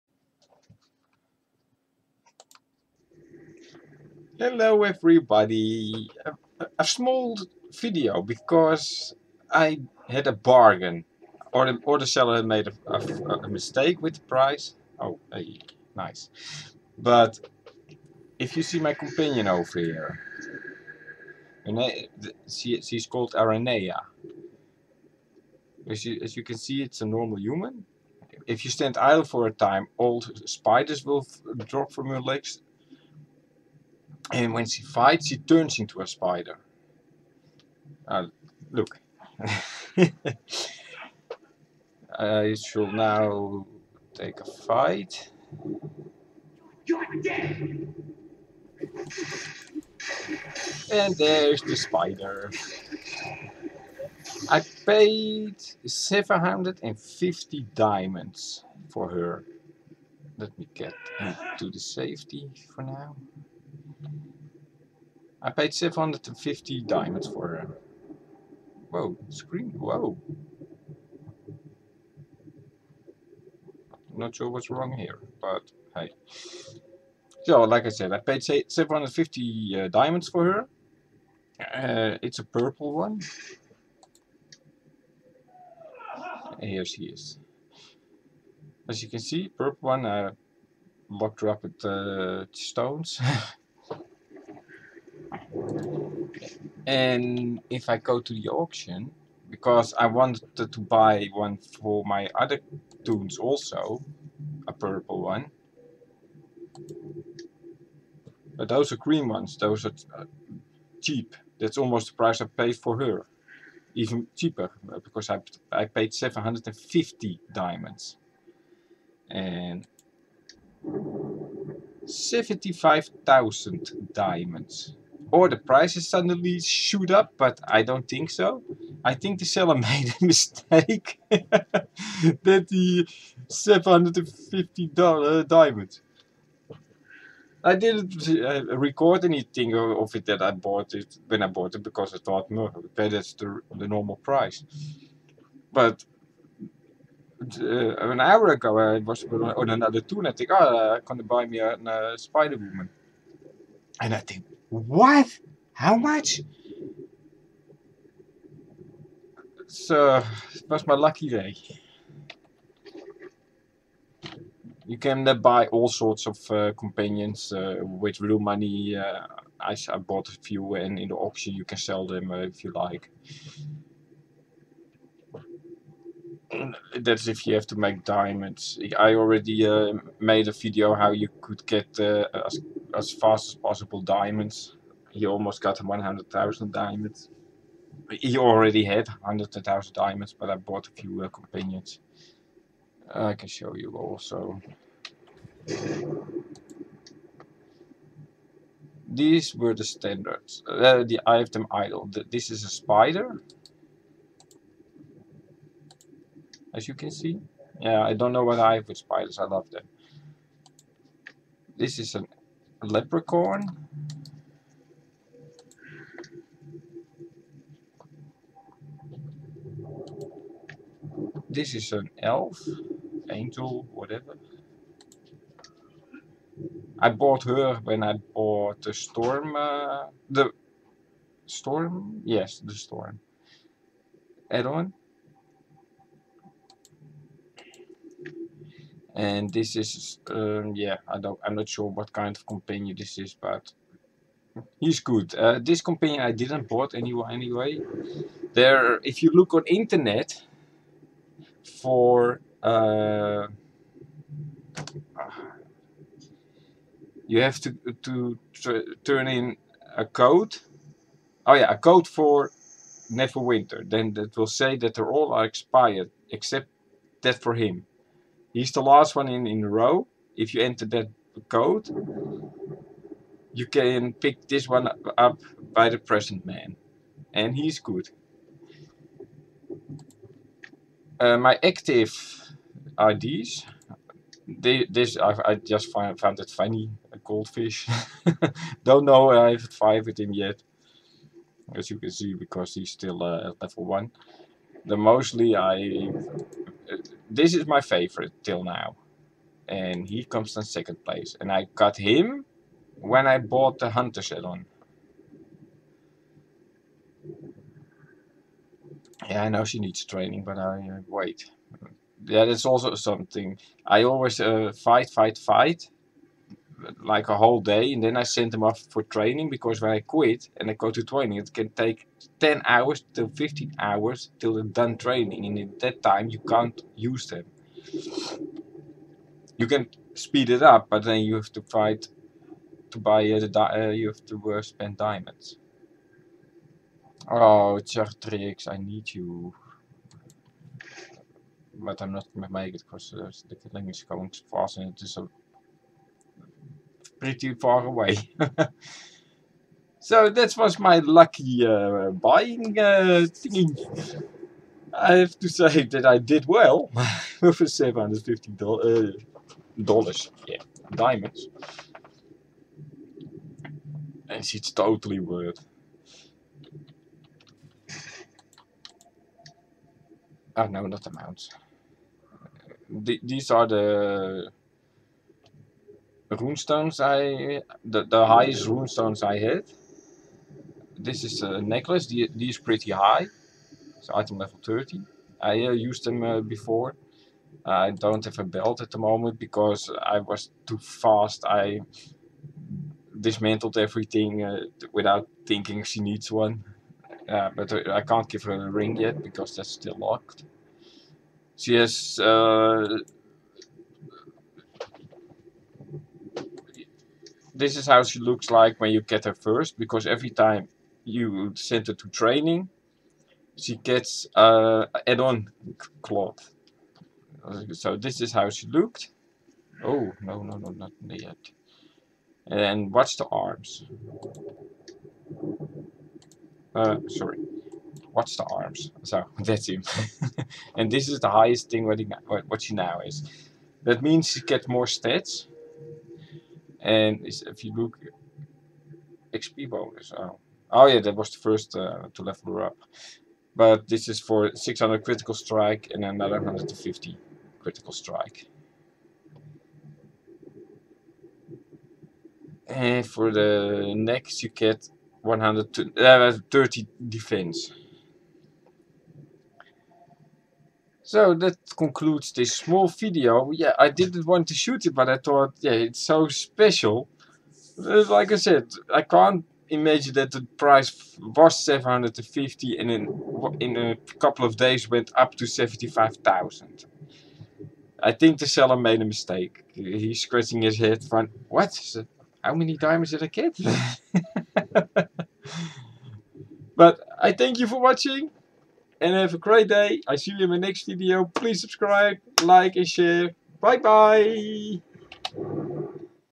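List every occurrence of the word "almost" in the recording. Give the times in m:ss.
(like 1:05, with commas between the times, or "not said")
1:51, 3:05.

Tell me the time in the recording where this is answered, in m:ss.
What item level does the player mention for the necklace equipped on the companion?
6:24.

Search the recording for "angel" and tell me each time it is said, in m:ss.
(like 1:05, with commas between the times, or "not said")
3:43.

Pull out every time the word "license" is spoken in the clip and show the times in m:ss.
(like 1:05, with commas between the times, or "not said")
not said.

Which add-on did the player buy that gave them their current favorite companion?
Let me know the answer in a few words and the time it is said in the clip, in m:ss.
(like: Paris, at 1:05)
Hunter, at 5:03.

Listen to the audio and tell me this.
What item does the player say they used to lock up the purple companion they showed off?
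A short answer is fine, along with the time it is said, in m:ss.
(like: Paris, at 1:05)
stones, at 1:32.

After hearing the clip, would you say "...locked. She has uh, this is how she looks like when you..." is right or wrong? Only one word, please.
right.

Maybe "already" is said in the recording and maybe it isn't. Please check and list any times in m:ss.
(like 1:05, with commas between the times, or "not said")
2:59, 3:08.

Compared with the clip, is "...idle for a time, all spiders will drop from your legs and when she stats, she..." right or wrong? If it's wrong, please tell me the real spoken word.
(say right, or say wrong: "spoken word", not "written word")
wrong: "fights", not "stats".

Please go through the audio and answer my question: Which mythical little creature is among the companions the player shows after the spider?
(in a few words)
leprechaun.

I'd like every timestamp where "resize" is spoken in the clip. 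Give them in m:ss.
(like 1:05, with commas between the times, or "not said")
not said.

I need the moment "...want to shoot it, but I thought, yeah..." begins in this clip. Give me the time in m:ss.
7:44.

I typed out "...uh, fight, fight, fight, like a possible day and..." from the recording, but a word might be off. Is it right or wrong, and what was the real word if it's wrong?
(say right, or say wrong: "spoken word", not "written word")
wrong: "whole", not "possible".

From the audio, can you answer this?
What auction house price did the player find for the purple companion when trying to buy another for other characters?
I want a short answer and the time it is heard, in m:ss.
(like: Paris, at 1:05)
75,000 diamonds, at 2:02.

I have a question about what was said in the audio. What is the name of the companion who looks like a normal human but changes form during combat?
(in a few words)
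Aranea.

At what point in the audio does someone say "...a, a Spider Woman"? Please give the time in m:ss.
2:31.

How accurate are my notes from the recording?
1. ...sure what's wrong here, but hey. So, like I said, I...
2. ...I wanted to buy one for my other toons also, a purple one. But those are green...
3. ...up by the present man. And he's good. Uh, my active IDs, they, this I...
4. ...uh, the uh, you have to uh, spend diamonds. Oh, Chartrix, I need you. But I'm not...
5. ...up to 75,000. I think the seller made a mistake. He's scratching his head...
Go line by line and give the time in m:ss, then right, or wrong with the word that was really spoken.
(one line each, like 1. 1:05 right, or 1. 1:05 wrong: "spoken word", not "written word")
1. 1:14 right
2. 1:39 right
3. 4:35 right
4. 5:33 right
5. 7:55 right.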